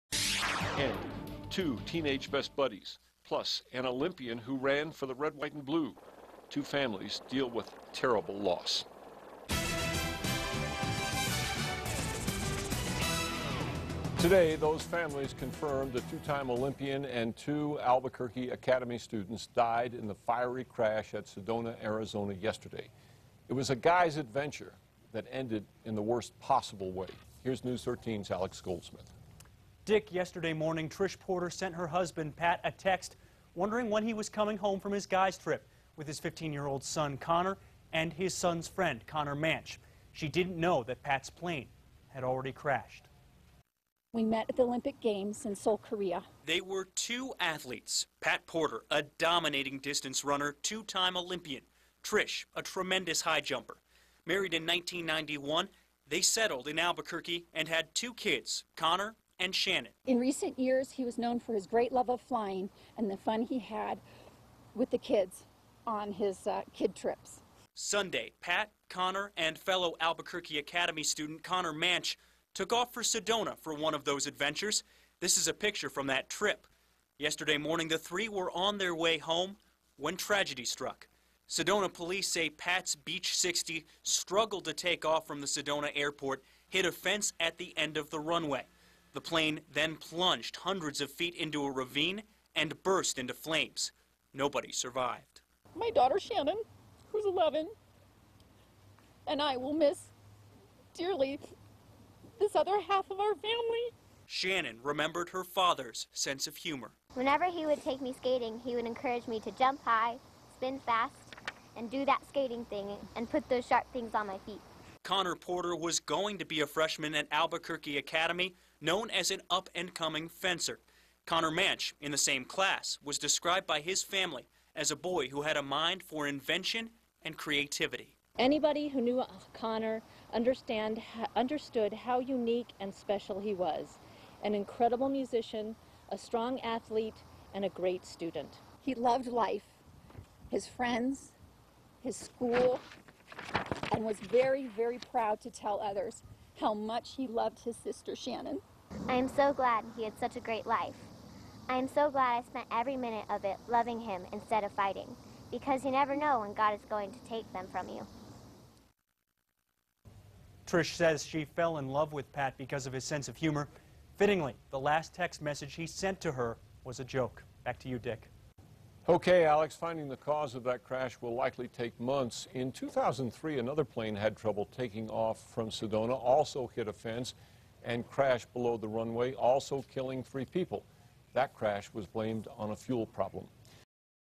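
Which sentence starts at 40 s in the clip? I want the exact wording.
She didn't know that Pat's plane had already crashed.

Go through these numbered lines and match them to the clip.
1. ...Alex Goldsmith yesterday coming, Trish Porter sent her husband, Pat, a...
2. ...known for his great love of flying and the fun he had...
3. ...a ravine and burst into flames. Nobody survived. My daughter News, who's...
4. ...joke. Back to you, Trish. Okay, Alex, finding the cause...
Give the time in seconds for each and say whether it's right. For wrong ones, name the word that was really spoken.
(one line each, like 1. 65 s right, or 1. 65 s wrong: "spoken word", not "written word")
1. 28 s wrong: "morning", not "coming"
2. 61 s right
3. 91 s wrong: "Shannon", not "News"
4. 167 s wrong: "Dick", not "Trish".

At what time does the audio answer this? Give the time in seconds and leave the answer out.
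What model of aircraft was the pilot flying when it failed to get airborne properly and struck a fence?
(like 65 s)
82 s.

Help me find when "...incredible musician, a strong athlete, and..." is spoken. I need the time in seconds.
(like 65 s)
134 s.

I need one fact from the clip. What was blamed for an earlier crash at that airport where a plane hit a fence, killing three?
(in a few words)
A fuel problem.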